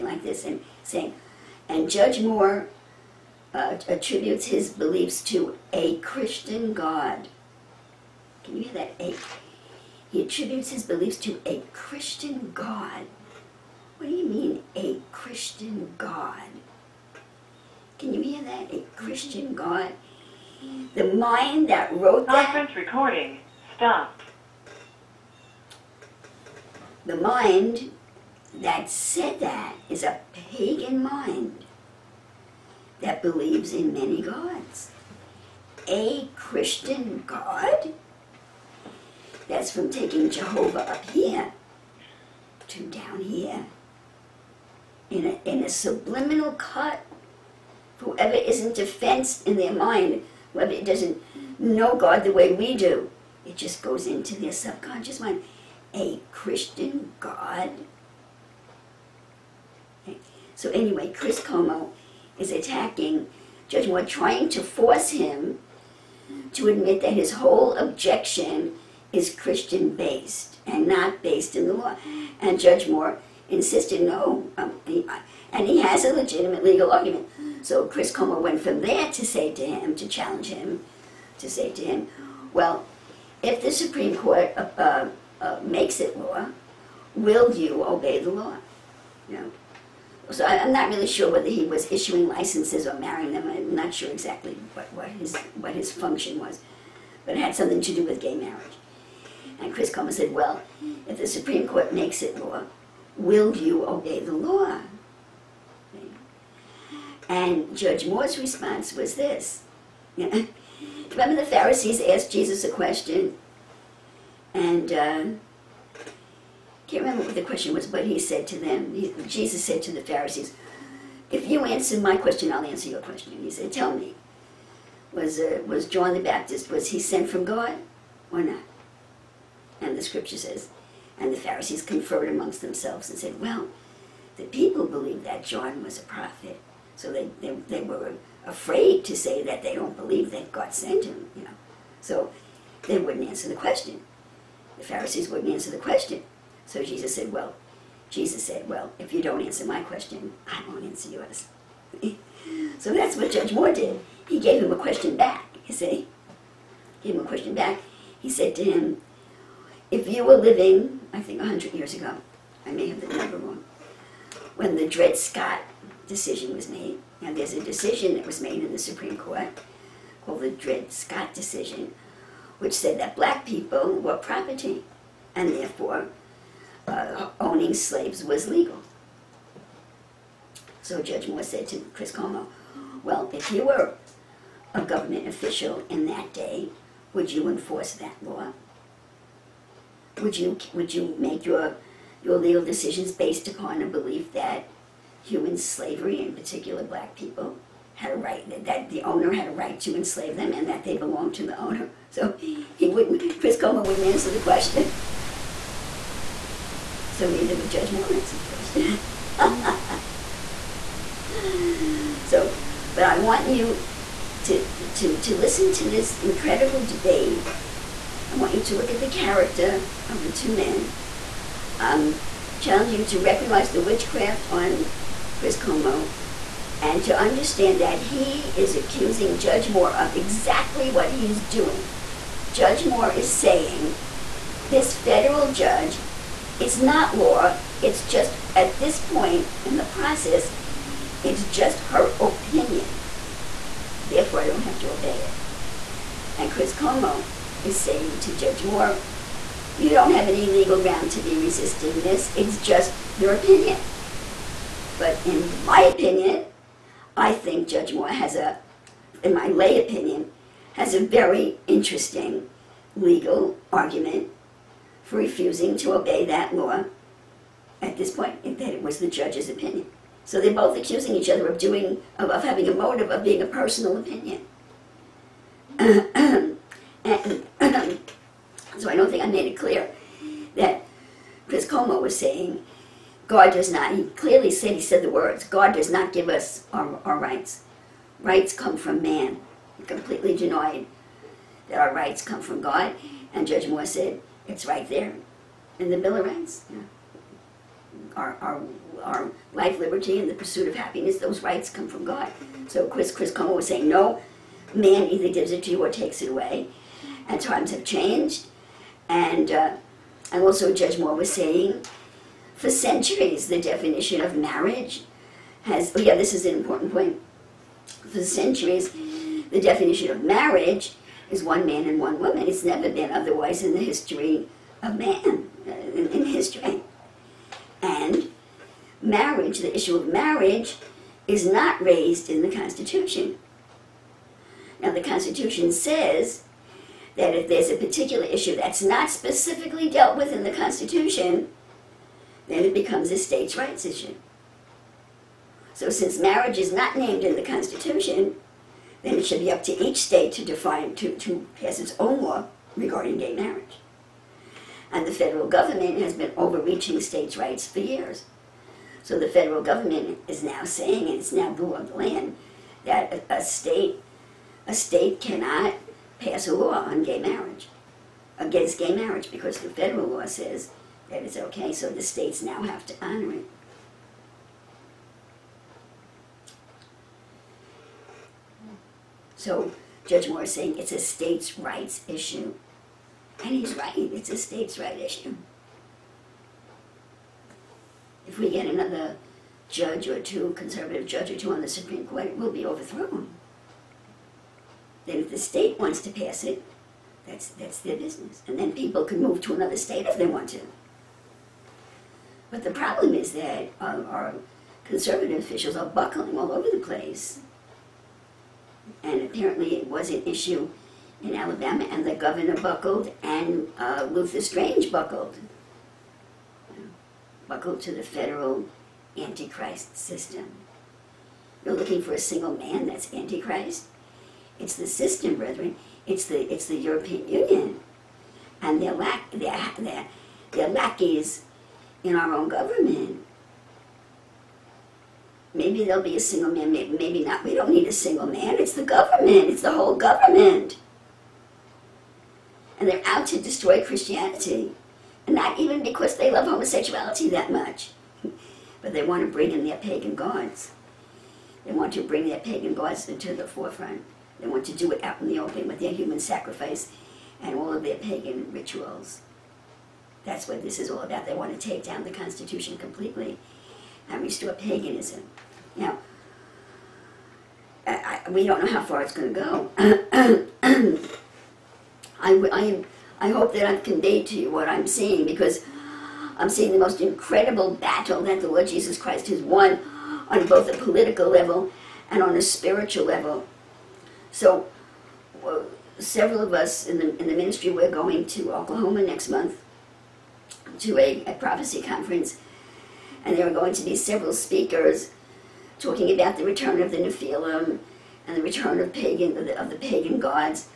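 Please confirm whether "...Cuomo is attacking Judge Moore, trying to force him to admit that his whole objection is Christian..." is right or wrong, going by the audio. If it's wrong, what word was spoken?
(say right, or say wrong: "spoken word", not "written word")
right.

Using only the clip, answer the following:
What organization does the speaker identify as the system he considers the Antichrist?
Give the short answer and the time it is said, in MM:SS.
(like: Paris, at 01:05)
European Union, at 07:06.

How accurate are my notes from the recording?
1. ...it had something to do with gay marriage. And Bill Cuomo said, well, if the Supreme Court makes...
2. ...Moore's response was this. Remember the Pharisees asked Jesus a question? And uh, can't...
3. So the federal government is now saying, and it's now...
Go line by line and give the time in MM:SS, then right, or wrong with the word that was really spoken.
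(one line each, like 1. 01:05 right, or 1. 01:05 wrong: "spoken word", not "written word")
1. 01:37 wrong: "Chris", not "Bill"
2. 01:48 right
3. 05:59 right.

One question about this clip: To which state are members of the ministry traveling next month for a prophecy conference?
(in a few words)
Oklahoma.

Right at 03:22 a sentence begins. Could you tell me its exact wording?
So he wouldn't, Chris Coleman wouldn't answer the question.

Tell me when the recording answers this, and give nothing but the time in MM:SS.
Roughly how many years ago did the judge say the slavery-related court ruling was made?
02:41.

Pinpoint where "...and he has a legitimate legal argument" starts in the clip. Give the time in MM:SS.
01:15.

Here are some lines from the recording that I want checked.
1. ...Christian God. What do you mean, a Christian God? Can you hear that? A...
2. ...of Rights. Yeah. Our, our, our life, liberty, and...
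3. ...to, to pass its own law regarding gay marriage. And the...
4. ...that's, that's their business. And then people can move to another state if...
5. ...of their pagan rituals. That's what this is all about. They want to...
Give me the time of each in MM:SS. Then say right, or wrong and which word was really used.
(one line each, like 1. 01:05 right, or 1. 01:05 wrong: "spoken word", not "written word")
1. 00:11 right
2. 04:56 right
3. 05:50 right
4. 06:37 right
5. 07:37 right.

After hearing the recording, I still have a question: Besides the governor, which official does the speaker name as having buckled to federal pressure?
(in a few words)
Luther Strange.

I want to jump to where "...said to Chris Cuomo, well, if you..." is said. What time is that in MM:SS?
03:01.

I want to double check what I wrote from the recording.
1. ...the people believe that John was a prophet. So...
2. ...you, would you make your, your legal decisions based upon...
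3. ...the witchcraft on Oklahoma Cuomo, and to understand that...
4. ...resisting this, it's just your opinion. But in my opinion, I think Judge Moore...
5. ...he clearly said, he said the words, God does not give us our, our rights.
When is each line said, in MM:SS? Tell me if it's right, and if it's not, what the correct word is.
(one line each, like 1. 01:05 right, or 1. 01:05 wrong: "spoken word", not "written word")
1. 02:14 right
2. 03:10 right
3. 03:43 wrong: "Chris", not "Oklahoma"
4. 04:11 right
5. 04:43 right.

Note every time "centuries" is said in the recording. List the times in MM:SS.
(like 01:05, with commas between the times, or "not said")
05:12, 05:18.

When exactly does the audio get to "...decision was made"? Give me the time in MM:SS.
02:46.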